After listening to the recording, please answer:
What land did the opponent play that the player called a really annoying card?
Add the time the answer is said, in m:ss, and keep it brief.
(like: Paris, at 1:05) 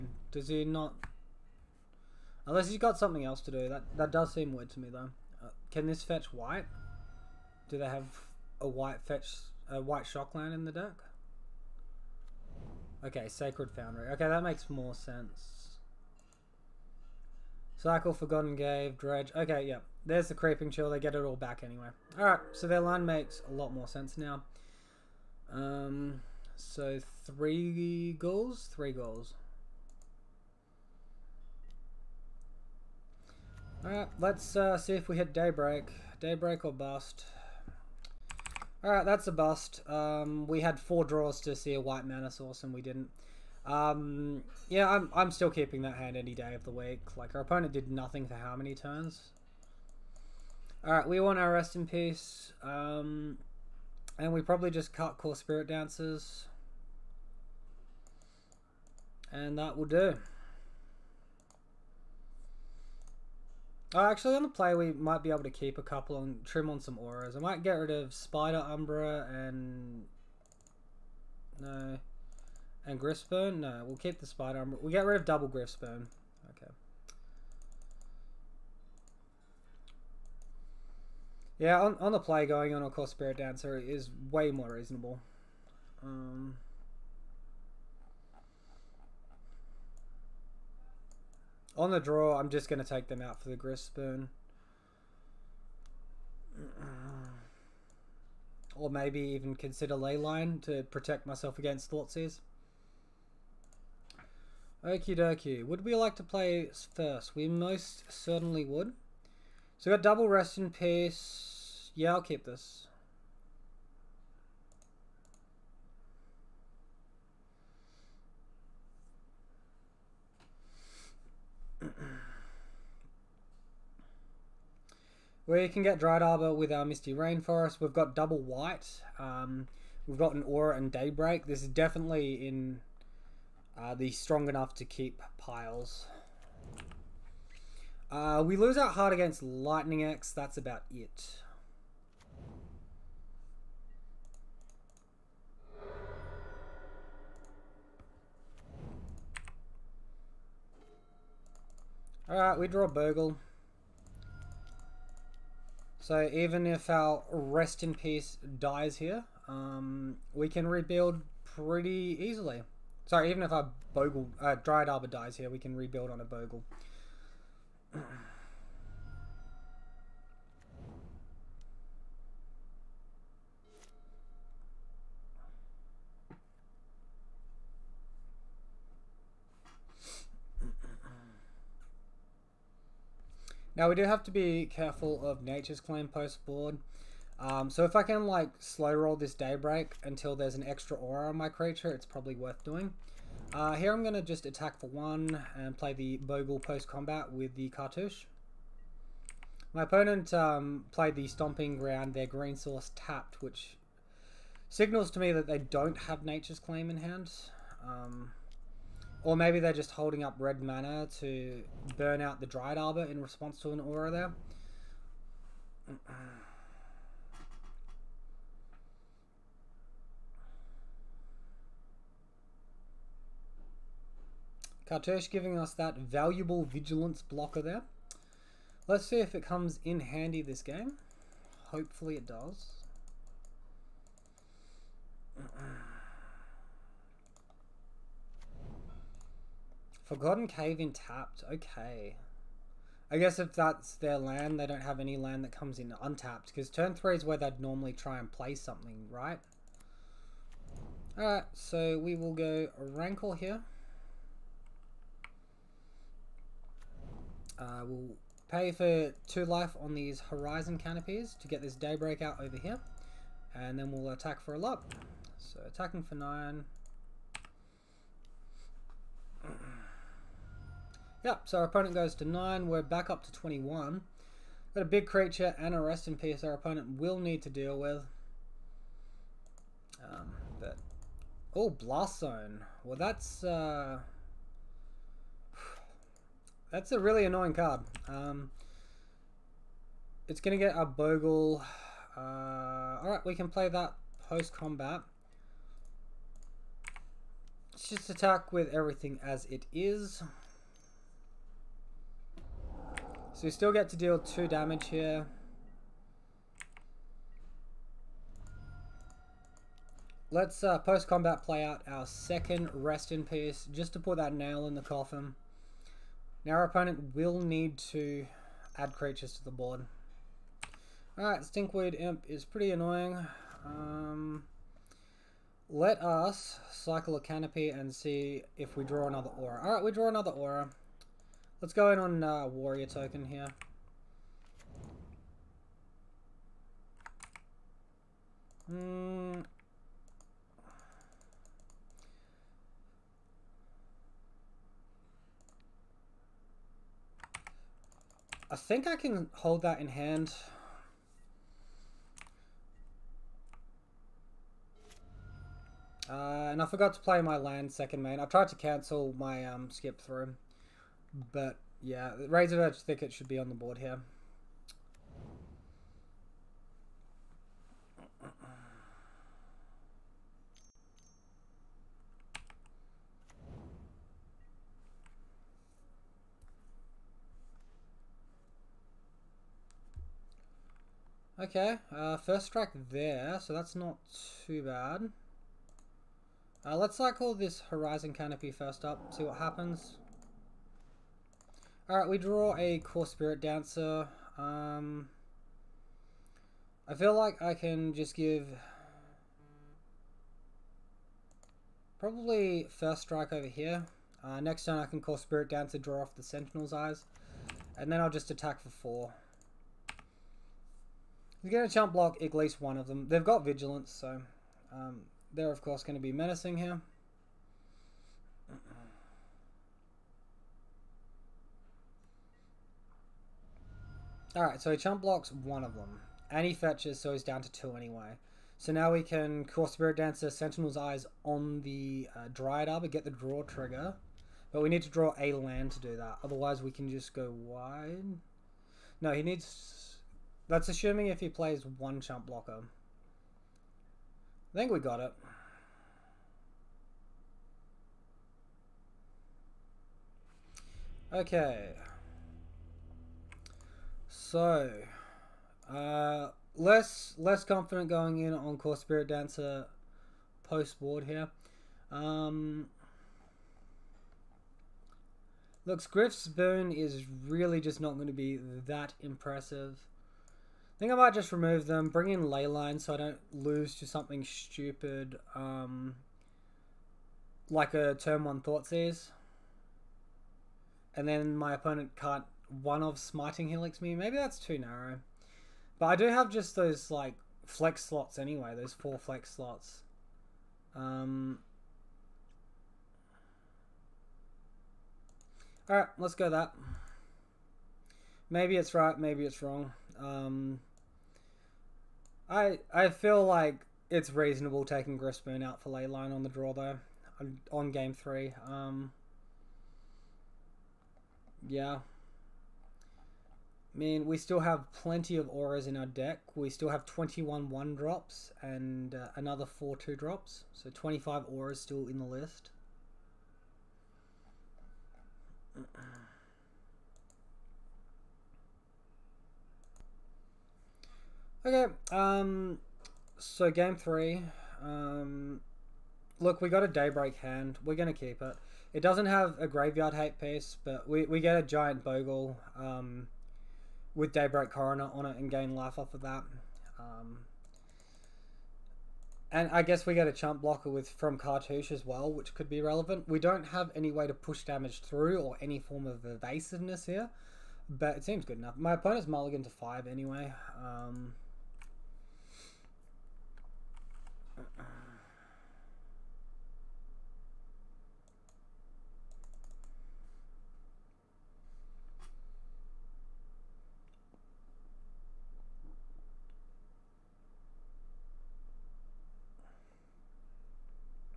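Blast Zone, at 4:41.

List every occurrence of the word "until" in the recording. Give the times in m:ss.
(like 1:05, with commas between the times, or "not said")
3:10.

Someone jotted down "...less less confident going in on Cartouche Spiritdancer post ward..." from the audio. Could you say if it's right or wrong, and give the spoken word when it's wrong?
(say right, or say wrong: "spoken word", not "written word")
wrong: "Kor", not "Cartouche".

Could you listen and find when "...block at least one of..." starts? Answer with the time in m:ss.
6:51.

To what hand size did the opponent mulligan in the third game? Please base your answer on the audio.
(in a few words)
5.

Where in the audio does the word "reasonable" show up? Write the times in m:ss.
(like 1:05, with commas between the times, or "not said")
1:24, 8:24.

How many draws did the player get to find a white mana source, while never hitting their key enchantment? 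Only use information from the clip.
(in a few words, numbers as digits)
4.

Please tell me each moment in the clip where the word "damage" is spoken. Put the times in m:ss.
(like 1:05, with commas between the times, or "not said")
5:04, 9:14.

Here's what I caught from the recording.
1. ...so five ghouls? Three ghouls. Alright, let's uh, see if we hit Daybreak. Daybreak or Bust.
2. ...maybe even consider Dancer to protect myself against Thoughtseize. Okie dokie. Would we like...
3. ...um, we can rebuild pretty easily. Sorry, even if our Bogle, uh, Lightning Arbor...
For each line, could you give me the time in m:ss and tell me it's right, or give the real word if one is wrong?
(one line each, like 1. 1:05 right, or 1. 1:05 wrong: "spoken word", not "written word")
1. 0:26 wrong: "three", not "five"
2. 1:38 wrong: "Leyline", not "Dancer"
3. 2:39 wrong: "Dryad", not "Lightning".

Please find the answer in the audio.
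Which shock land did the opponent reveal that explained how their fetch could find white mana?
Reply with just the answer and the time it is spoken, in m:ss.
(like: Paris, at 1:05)
Sacred Foundry, at 0:13.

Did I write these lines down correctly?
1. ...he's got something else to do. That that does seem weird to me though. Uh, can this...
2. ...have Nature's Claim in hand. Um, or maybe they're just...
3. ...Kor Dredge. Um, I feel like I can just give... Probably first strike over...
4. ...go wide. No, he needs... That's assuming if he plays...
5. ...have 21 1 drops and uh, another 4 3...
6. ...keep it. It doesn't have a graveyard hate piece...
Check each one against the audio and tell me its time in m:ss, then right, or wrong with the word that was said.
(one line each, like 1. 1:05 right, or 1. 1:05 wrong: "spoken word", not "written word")
1. 0:02 right
2. 3:25 right
3. 6:32 wrong: "Spiritdancer", not "Dredge"
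4. 7:17 right
5. 8:36 wrong: "2", not "3"
6. 8:57 right.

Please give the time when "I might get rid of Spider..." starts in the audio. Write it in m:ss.
1:07.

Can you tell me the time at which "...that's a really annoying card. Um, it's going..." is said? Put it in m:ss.
4:46.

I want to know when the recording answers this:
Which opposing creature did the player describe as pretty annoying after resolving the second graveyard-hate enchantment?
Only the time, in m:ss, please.
5:21.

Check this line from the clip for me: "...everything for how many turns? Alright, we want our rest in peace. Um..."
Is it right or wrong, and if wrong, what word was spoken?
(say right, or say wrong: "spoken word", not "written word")
wrong: "nothing", not "everything".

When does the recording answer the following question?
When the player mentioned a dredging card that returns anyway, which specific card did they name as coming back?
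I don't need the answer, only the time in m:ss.
0:20.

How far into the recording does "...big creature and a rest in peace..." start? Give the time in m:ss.
4:34.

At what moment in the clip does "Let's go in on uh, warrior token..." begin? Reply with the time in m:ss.
5:31.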